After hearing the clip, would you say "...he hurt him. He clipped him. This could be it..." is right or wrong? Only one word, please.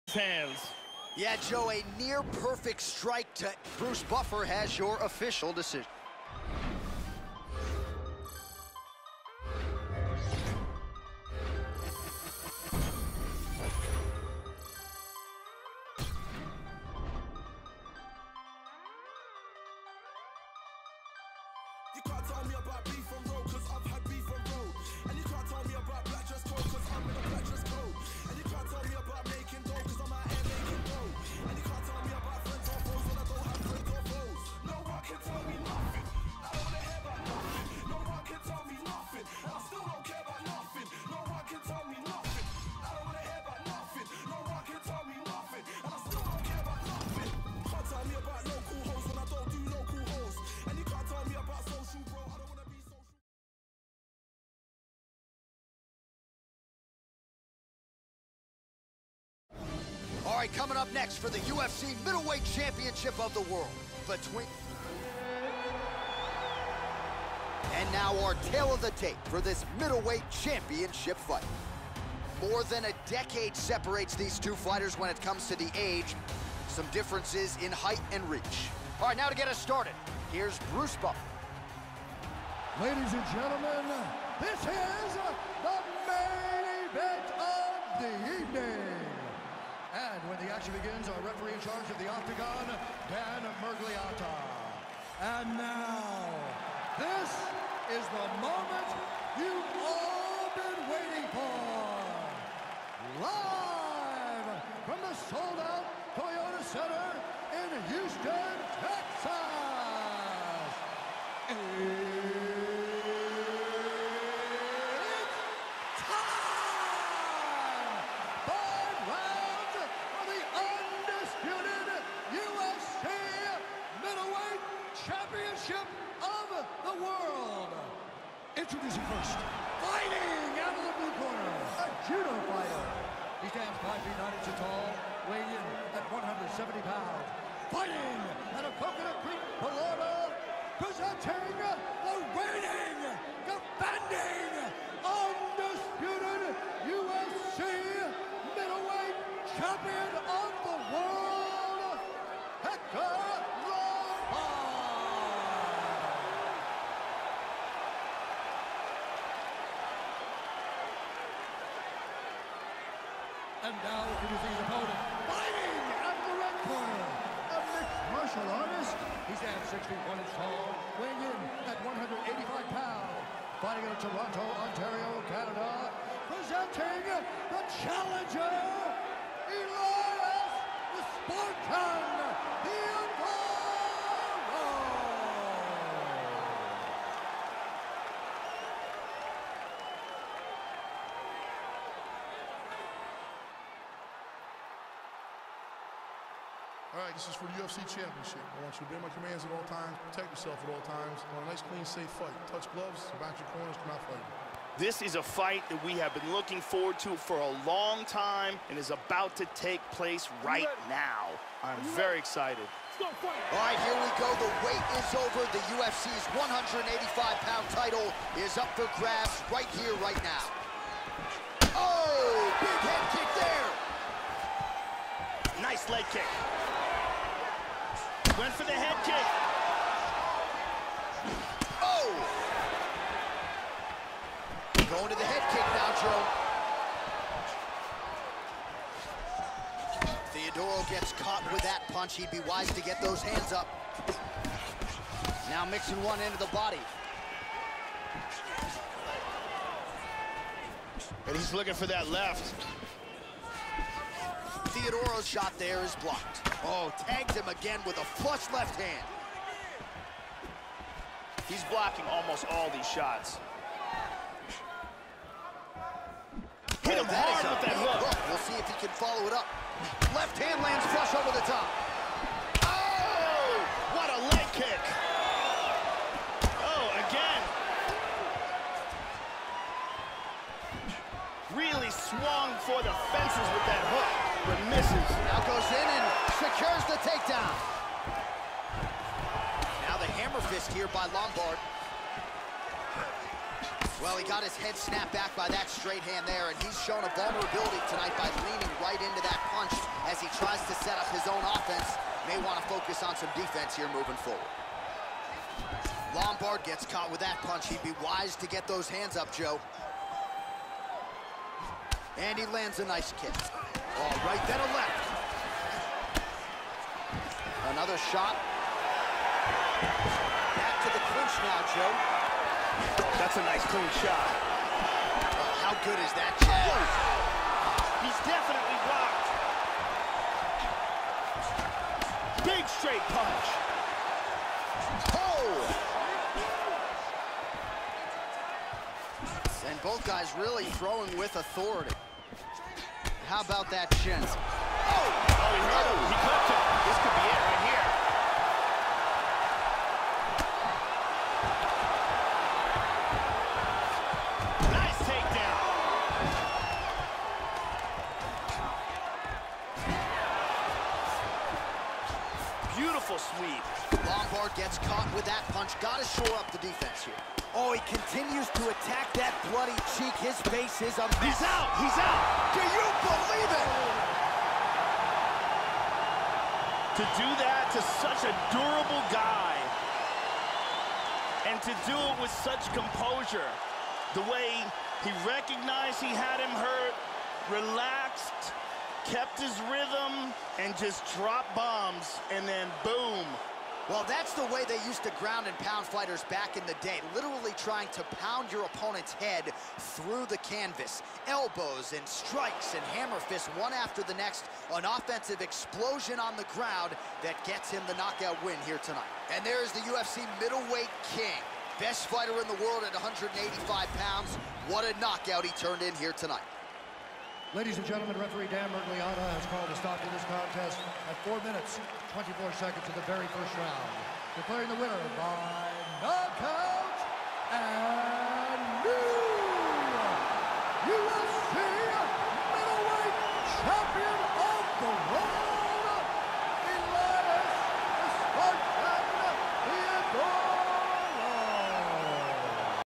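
right.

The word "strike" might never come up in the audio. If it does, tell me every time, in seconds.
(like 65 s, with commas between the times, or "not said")
2 s, 402 s.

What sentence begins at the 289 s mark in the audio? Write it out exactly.
Now the hammer fist here by Lombard.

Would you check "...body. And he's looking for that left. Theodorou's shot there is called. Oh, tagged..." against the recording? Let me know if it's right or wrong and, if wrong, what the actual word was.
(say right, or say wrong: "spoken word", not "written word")
wrong: "blocked", not "called".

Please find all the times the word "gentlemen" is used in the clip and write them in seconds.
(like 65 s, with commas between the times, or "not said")
83 s, 417 s.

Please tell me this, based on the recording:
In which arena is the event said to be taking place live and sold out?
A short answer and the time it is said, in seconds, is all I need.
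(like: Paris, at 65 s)
Toyota Center, at 106 s.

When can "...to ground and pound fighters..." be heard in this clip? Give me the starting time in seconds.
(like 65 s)
395 s.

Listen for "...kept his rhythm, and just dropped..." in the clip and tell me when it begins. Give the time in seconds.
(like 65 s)
389 s.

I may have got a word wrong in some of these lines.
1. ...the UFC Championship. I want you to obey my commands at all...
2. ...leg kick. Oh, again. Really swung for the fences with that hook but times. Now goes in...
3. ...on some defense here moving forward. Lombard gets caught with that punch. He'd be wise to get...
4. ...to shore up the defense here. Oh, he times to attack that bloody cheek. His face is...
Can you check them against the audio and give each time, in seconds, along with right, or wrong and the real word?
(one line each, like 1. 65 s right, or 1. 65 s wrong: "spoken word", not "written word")
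1. 197 s right
2. 274 s wrong: "misses", not "times"
3. 303 s right
4. 366 s wrong: "continues", not "times".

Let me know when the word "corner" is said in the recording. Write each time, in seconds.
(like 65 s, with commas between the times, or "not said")
131 s, 166 s, 203 s.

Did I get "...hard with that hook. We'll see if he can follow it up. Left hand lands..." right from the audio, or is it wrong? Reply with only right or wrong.
right.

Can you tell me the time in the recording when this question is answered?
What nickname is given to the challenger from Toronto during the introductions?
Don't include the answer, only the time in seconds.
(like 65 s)
180 s.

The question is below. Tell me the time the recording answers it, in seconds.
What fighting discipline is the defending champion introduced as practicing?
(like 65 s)
132 s.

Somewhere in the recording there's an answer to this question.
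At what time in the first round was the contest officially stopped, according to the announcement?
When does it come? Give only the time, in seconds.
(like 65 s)
421 s.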